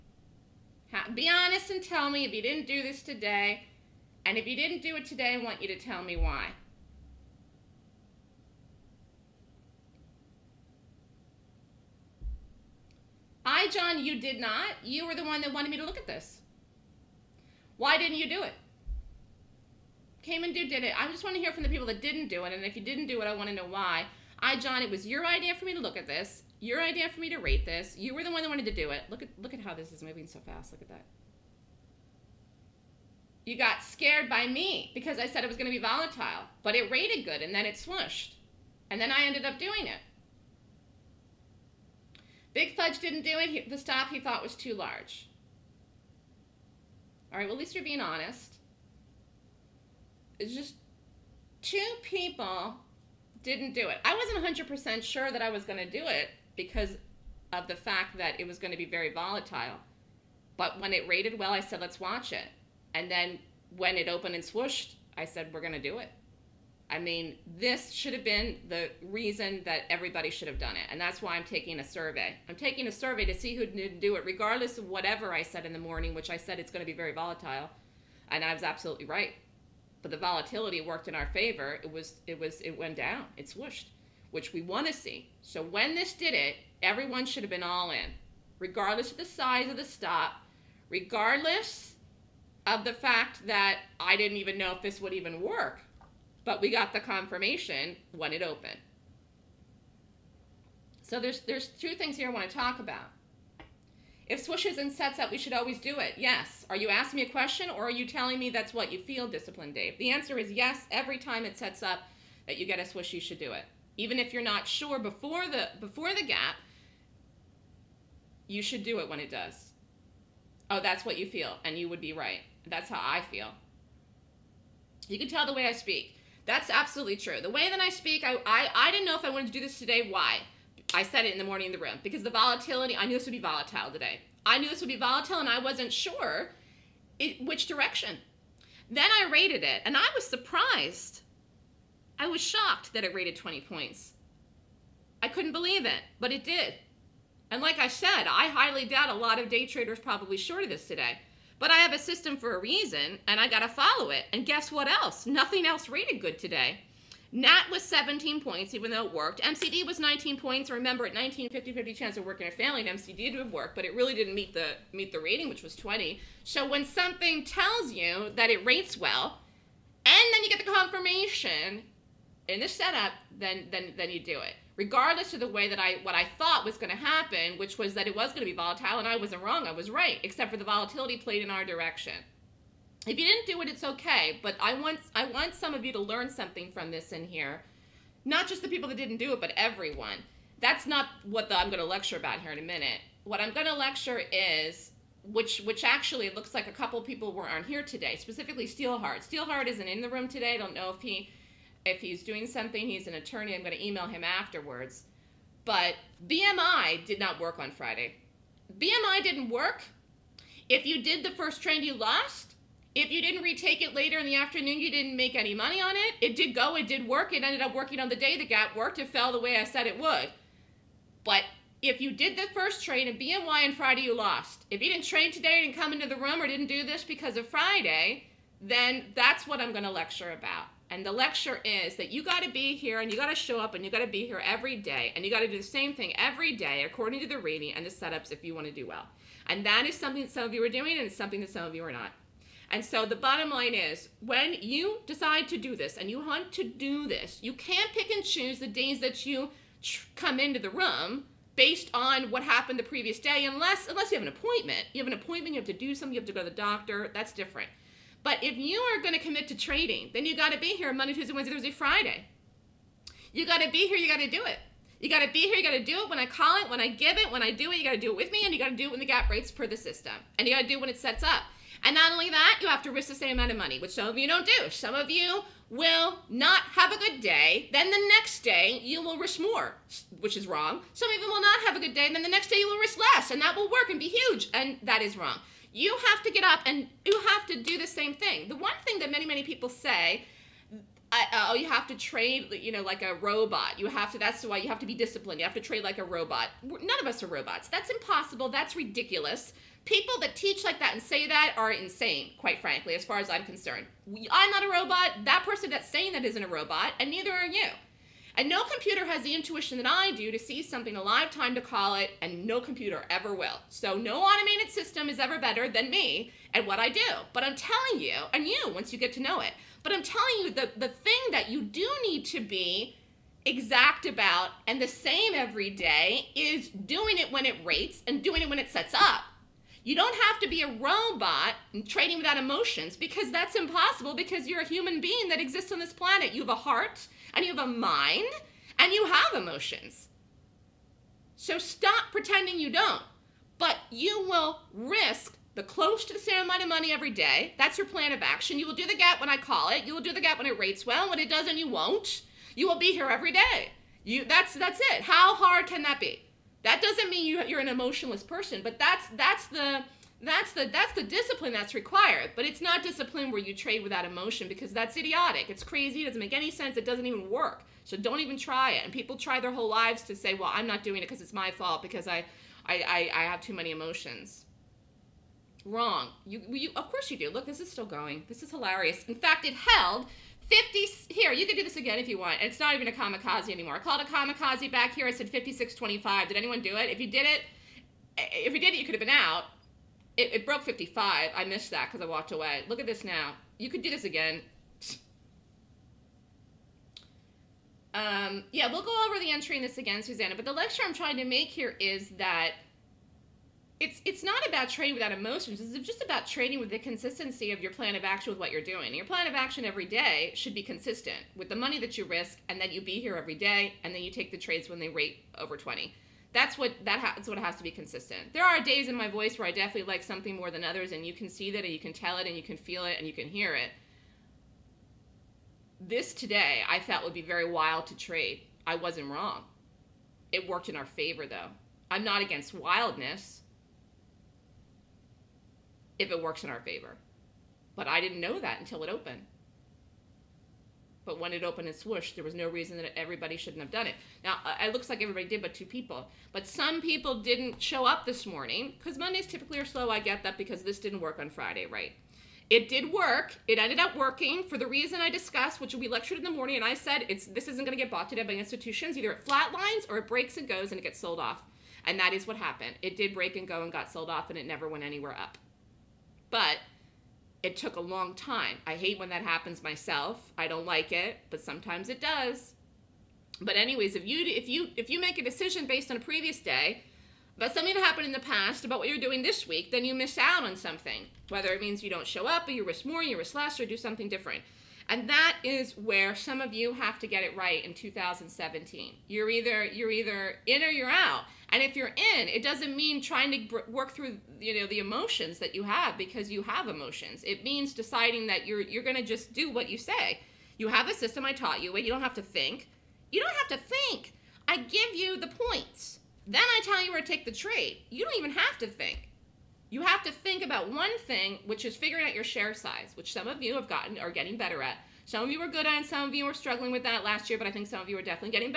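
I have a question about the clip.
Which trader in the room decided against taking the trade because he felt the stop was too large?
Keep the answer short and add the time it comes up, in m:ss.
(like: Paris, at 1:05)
Big Fudge, at 0:42.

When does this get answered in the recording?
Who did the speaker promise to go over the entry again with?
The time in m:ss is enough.
6:40.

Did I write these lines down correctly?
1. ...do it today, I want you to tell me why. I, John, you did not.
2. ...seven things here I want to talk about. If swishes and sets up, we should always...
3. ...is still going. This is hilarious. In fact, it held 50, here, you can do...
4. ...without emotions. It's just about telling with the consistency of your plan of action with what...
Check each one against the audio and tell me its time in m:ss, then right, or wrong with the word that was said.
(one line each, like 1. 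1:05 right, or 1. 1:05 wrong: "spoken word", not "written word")
1. 0:04 right
2. 1:41 wrong: "two", not "seven"
3. 6:17 right
4. 6:44 wrong: "trading", not "telling".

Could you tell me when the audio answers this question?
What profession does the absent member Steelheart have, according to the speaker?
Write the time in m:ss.
3:22.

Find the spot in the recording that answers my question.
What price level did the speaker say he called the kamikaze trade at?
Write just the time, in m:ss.
6:25.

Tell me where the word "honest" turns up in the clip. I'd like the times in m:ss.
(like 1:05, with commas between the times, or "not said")
0:01, 0:48.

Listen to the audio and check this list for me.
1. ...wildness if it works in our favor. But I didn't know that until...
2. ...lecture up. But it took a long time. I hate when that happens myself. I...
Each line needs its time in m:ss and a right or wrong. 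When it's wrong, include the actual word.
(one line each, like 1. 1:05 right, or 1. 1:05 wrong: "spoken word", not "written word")
1. 7:12 right
2. 7:44 wrong: "anywhere", not "lecture".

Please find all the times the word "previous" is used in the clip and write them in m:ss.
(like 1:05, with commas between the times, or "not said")
4:12, 7:56.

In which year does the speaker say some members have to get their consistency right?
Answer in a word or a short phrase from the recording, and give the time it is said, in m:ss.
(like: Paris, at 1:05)
2017, at 8:07.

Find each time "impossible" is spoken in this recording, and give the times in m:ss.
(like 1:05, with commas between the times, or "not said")
4:57, 5:33.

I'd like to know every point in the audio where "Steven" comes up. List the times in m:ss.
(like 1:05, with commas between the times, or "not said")
not said.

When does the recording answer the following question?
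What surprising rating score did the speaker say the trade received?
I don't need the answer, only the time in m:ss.
2:23.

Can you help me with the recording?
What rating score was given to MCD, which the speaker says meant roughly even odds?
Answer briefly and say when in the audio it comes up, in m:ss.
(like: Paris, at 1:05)
19, at 2:39.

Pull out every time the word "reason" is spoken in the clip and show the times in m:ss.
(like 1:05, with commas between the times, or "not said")
1:09, 2:32, 7:22, 7:34.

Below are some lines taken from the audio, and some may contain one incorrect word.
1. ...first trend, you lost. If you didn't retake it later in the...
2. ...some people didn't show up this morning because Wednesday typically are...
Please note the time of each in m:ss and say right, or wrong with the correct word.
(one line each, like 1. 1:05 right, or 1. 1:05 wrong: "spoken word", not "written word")
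1. 3:31 right
2. 7:26 wrong: "Mondays", not "Wednesday".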